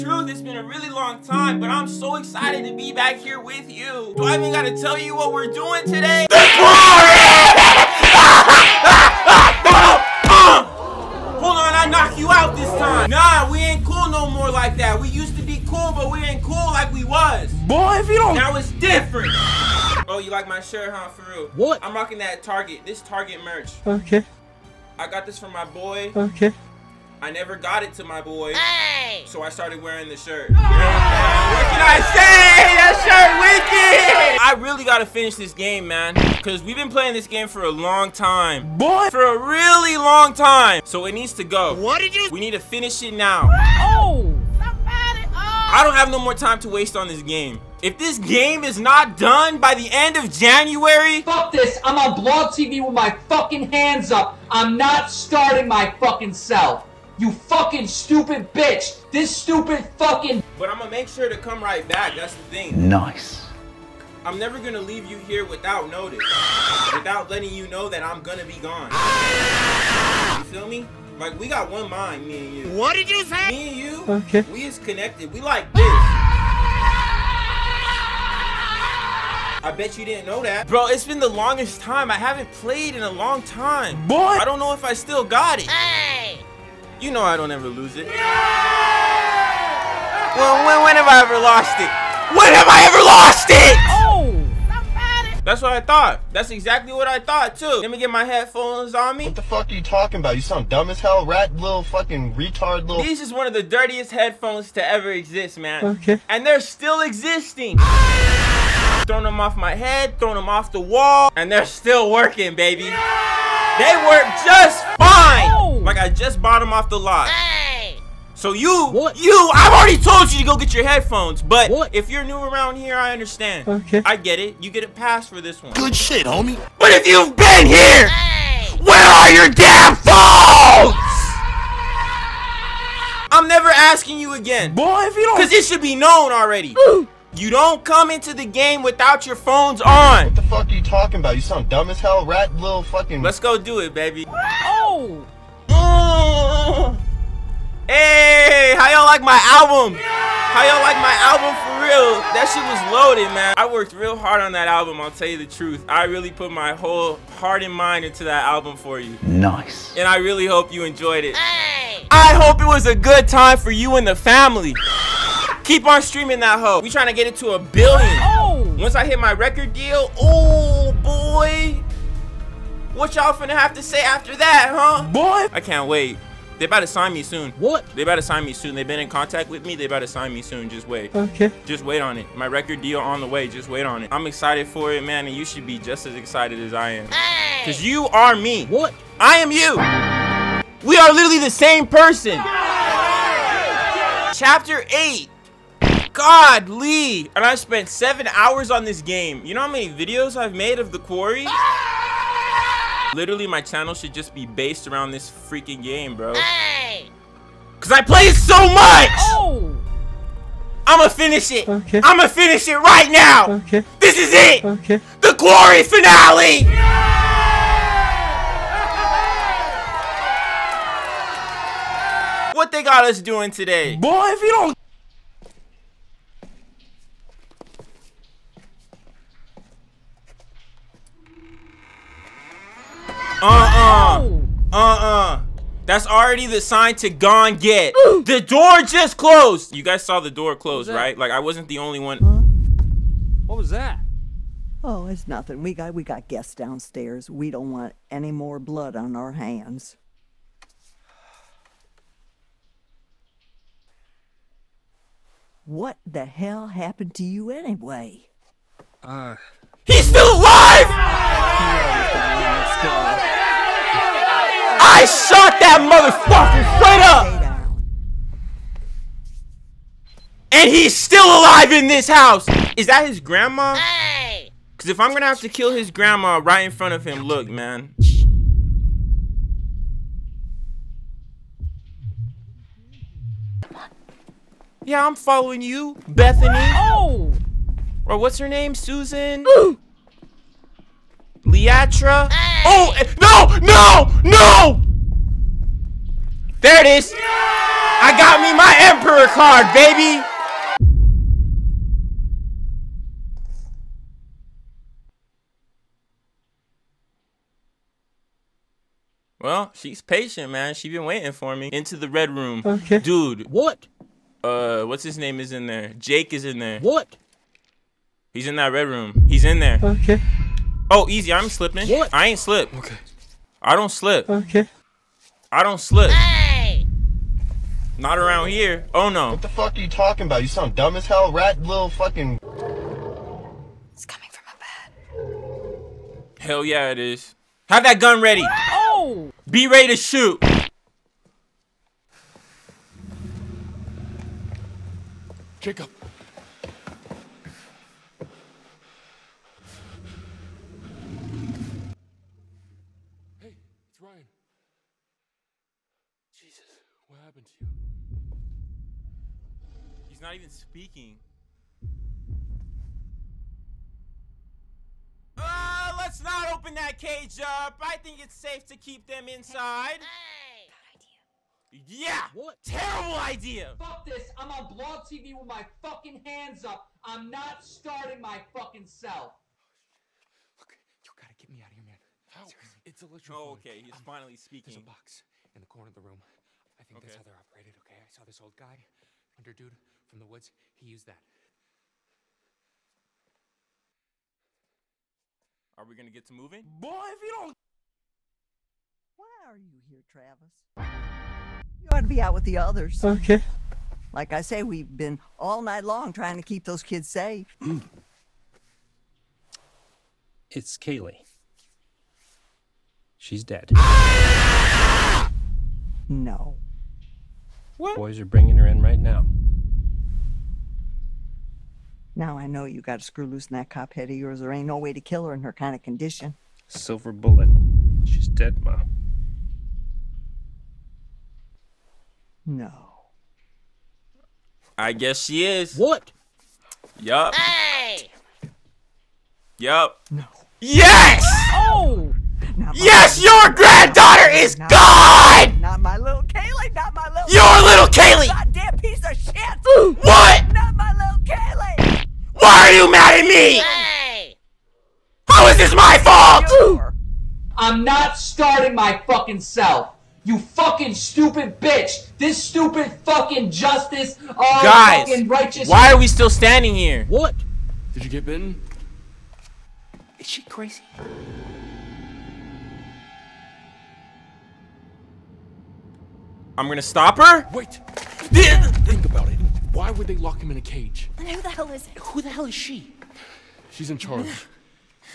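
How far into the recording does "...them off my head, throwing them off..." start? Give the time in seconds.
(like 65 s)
109 s.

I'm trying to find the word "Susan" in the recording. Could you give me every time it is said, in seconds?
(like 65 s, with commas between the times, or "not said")
288 s.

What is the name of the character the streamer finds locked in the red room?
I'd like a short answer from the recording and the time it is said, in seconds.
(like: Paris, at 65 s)
Jake, at 315 s.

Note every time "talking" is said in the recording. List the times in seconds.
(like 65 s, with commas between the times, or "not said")
99 s, 140 s, 329 s.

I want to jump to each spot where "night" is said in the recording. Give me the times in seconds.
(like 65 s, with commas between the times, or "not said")
405 s.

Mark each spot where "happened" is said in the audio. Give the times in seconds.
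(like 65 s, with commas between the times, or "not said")
256 s, 357 s.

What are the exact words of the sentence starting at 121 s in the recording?
if you're new around here, I understand.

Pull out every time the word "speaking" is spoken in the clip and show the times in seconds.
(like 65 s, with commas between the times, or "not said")
360 s, 384 s.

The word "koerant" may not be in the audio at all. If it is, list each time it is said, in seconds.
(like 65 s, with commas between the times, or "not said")
not said.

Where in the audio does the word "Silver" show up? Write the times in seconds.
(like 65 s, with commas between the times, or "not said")
426 s.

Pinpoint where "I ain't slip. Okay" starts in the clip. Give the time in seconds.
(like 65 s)
322 s.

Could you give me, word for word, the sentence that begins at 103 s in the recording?
These is one of the dirtiest headphones to ever exist, man.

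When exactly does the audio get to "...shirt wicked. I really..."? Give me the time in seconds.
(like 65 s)
33 s.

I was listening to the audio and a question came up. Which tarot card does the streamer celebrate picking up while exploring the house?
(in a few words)
Emperor.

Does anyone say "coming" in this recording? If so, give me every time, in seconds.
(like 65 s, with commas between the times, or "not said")
334 s.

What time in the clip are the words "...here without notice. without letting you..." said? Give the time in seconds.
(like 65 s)
65 s.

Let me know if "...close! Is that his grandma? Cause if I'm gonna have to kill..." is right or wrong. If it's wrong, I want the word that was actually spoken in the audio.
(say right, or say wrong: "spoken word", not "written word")
wrong: "house", not "close".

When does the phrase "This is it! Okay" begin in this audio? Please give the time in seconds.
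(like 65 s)
213 s.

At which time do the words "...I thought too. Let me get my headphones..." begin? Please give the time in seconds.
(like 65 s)
97 s.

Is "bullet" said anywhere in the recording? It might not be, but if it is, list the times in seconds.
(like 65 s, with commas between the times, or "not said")
427 s.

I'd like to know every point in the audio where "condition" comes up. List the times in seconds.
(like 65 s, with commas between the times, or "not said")
425 s.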